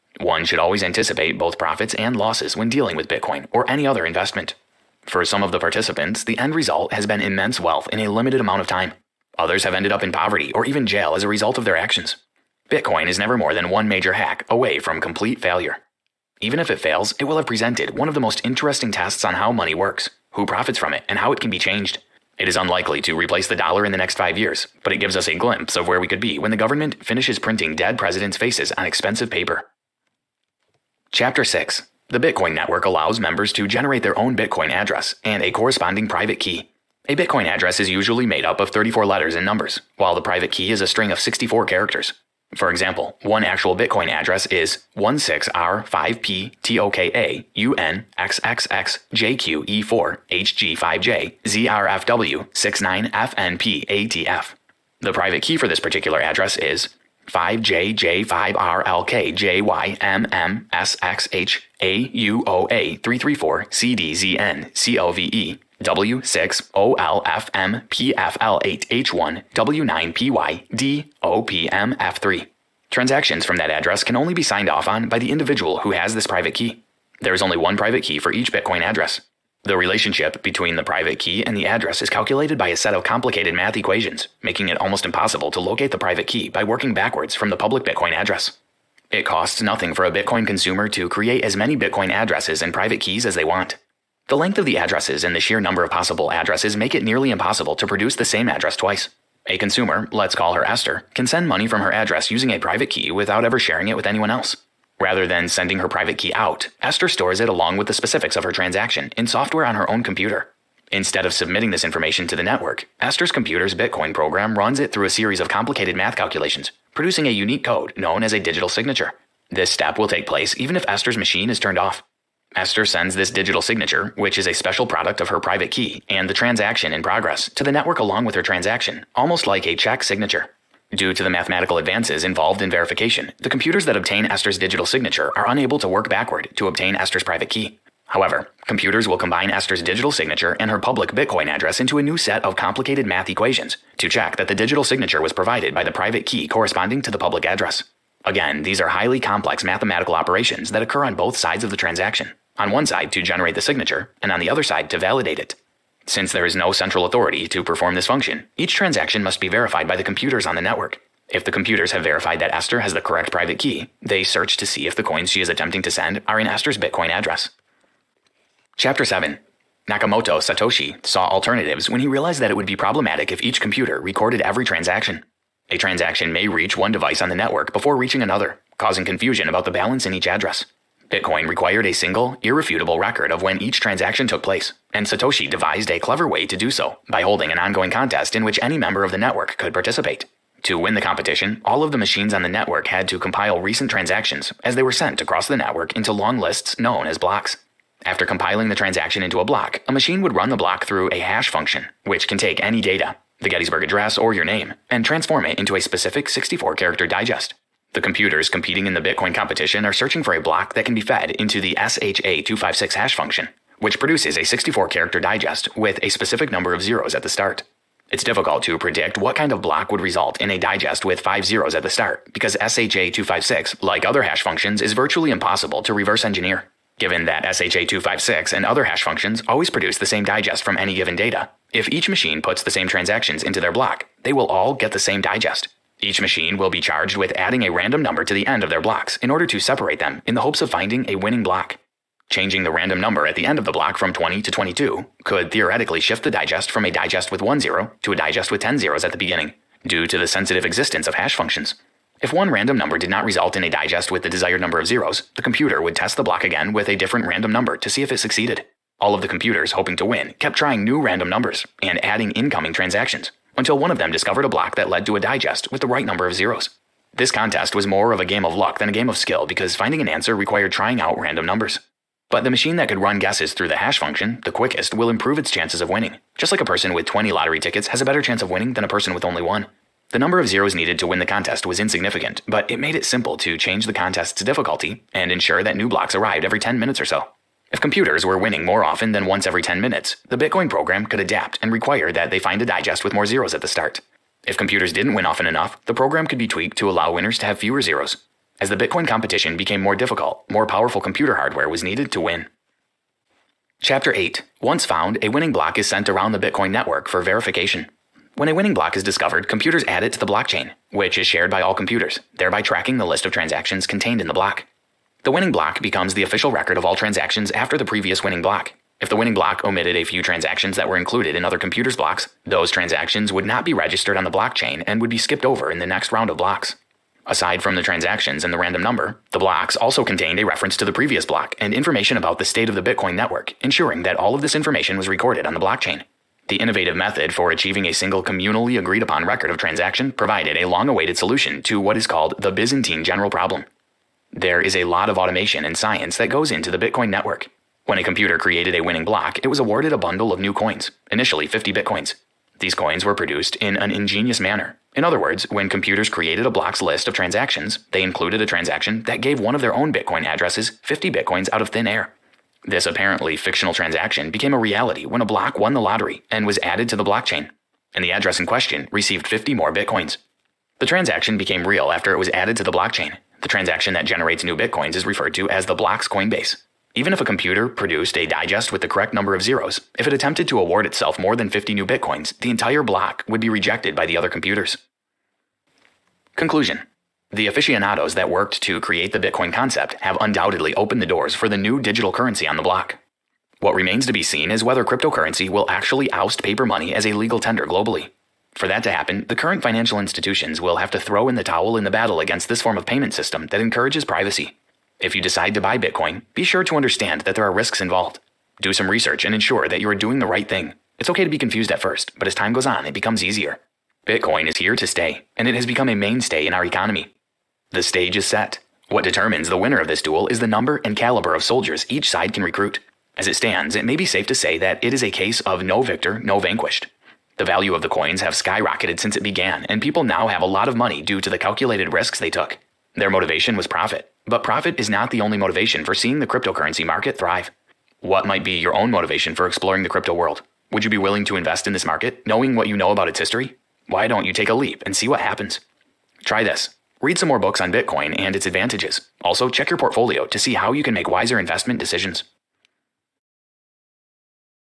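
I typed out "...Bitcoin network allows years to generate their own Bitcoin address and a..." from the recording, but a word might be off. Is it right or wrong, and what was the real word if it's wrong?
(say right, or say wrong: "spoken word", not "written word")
wrong: "members", not "years".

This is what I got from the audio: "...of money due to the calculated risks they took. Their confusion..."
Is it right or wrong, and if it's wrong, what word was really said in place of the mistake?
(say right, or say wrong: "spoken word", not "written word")
wrong: "motivation", not "confusion".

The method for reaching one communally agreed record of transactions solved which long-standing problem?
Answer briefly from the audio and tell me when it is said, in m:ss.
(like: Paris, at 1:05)
Byzantine general problem, at 5:42.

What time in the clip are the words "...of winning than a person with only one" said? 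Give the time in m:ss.
4:38.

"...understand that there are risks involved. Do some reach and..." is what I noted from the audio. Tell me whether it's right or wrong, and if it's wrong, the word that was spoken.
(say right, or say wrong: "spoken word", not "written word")
wrong: "research", not "reach".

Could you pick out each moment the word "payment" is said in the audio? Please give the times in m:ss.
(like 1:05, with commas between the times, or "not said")
6:42.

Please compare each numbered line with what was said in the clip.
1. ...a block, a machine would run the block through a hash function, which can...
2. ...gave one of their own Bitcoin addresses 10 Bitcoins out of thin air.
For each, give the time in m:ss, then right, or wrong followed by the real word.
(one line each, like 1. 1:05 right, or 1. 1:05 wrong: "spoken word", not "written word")
1. 3:19 right
2. 5:59 wrong: "50", not "10".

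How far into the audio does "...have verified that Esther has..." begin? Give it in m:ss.
2:41.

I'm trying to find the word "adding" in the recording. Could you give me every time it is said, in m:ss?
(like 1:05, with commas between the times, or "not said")
3:57, 4:22.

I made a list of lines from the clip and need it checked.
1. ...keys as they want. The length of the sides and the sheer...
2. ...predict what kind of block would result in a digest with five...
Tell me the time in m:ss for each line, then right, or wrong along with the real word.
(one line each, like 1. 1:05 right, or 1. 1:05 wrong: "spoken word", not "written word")
1. 1:33 wrong: "addresses", not "sides"
2. 3:38 right.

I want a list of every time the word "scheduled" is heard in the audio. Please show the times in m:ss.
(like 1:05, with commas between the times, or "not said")
not said.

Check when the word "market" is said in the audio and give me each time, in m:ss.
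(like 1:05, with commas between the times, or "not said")
7:16, 7:21.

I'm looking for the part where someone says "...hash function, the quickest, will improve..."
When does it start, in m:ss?
4:33.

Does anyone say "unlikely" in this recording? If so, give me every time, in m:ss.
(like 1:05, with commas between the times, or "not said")
0:22.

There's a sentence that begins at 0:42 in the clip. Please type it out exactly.
For example, one actual Bitcoin address is 16R5PTOKAUNXXXJQE4HG5JZRFW69FNPATF.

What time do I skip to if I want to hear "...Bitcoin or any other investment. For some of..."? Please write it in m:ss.
0:03.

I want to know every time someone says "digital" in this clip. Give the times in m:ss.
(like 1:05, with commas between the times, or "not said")
1:58, 2:03, 2:14, 2:19, 2:24, 6:31.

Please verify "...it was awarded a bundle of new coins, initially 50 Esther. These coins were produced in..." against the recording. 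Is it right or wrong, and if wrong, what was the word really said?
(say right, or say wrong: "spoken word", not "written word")
wrong: "Bitcoins", not "Esther".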